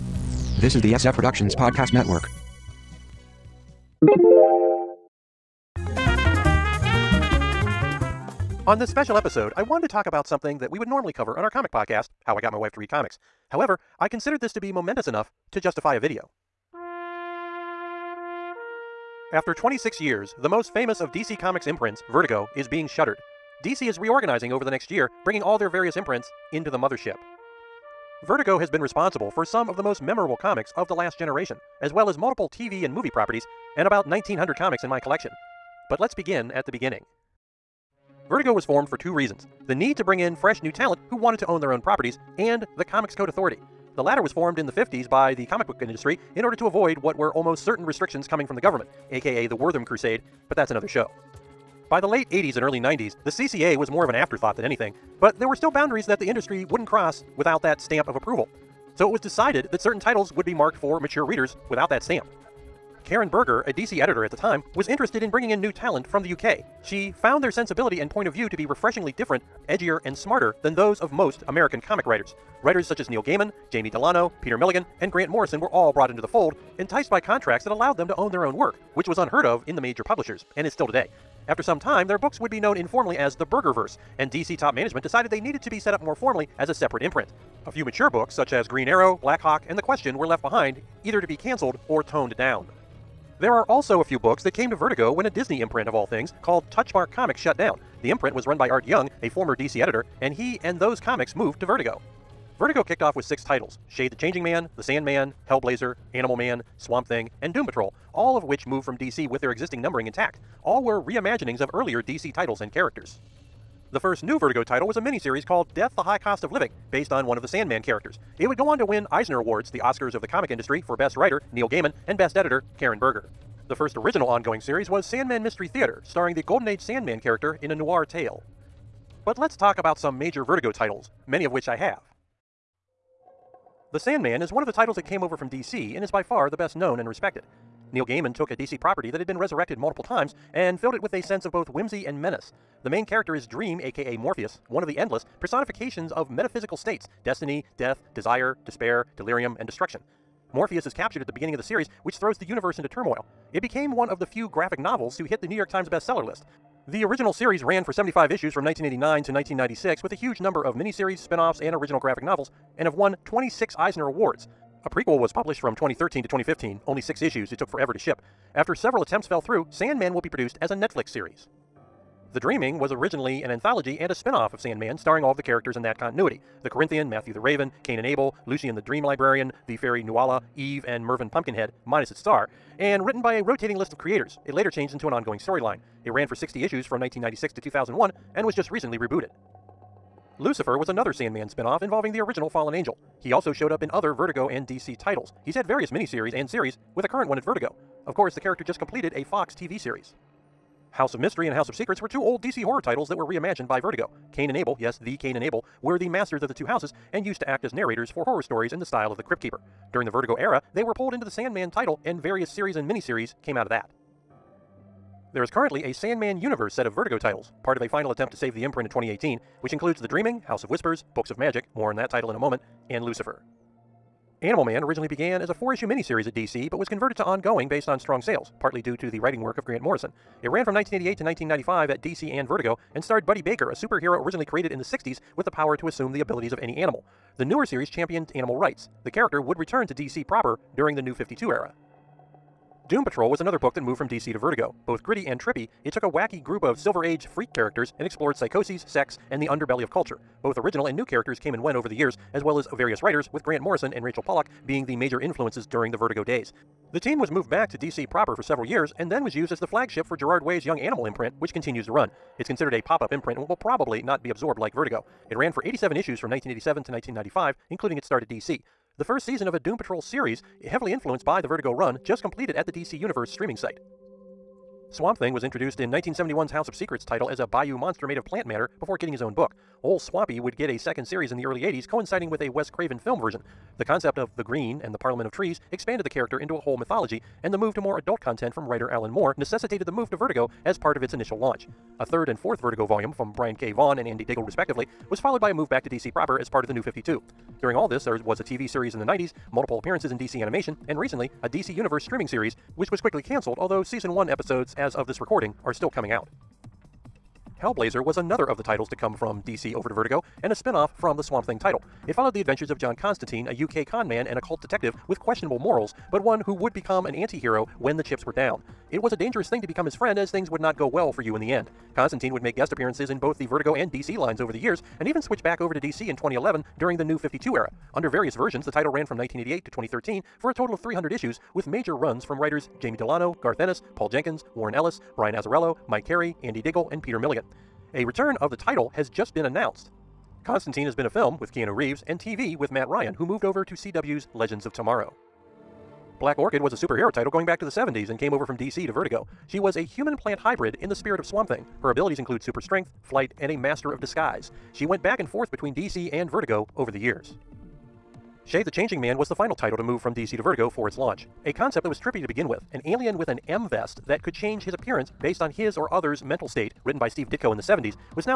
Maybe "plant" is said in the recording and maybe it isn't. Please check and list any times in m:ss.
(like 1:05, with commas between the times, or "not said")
4:38, 5:50.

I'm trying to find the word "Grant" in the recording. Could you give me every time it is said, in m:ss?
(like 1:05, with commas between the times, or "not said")
1:15, 3:49, 4:13.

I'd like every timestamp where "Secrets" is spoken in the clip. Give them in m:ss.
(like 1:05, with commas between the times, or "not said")
3:21, 4:36.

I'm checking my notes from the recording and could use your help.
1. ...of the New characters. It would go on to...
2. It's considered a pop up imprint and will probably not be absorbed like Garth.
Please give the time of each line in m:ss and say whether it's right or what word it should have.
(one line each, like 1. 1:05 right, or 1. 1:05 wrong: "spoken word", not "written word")
1. 1:57 wrong: "Sandman", not "New"
2. 4:22 wrong: "Vertigo", not "Garth".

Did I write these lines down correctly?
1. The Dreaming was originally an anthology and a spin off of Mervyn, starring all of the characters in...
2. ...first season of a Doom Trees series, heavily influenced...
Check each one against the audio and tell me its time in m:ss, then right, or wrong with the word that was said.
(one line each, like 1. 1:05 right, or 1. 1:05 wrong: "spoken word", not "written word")
1. 2:52 wrong: "Sandman", not "Mervyn"
2. 4:29 wrong: "Patrol", not "Trees".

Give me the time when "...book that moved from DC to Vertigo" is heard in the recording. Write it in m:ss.
4:03.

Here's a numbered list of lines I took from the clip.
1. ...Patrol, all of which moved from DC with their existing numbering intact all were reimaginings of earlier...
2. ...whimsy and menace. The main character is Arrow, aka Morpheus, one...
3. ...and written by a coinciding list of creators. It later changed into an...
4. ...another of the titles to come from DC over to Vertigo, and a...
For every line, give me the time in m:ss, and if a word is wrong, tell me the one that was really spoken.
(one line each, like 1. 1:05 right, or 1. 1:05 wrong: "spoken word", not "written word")
1. 1:47 right
2. 2:21 wrong: "Dream", not "Arrow"
3. 3:02 wrong: "rotating", not "coinciding"
4. 5:08 right.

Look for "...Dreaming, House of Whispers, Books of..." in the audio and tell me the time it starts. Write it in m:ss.
3:40.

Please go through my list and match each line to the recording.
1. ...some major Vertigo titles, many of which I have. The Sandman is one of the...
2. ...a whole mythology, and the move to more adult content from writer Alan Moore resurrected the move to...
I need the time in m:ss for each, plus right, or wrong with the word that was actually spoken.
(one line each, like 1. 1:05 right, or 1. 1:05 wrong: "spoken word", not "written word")
1. 2:09 right
2. 4:46 wrong: "necessitated", not "resurrected".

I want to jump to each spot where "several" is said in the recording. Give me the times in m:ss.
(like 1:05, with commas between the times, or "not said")
2:48, 4:18.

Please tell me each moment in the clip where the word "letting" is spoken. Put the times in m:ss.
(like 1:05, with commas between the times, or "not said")
not said.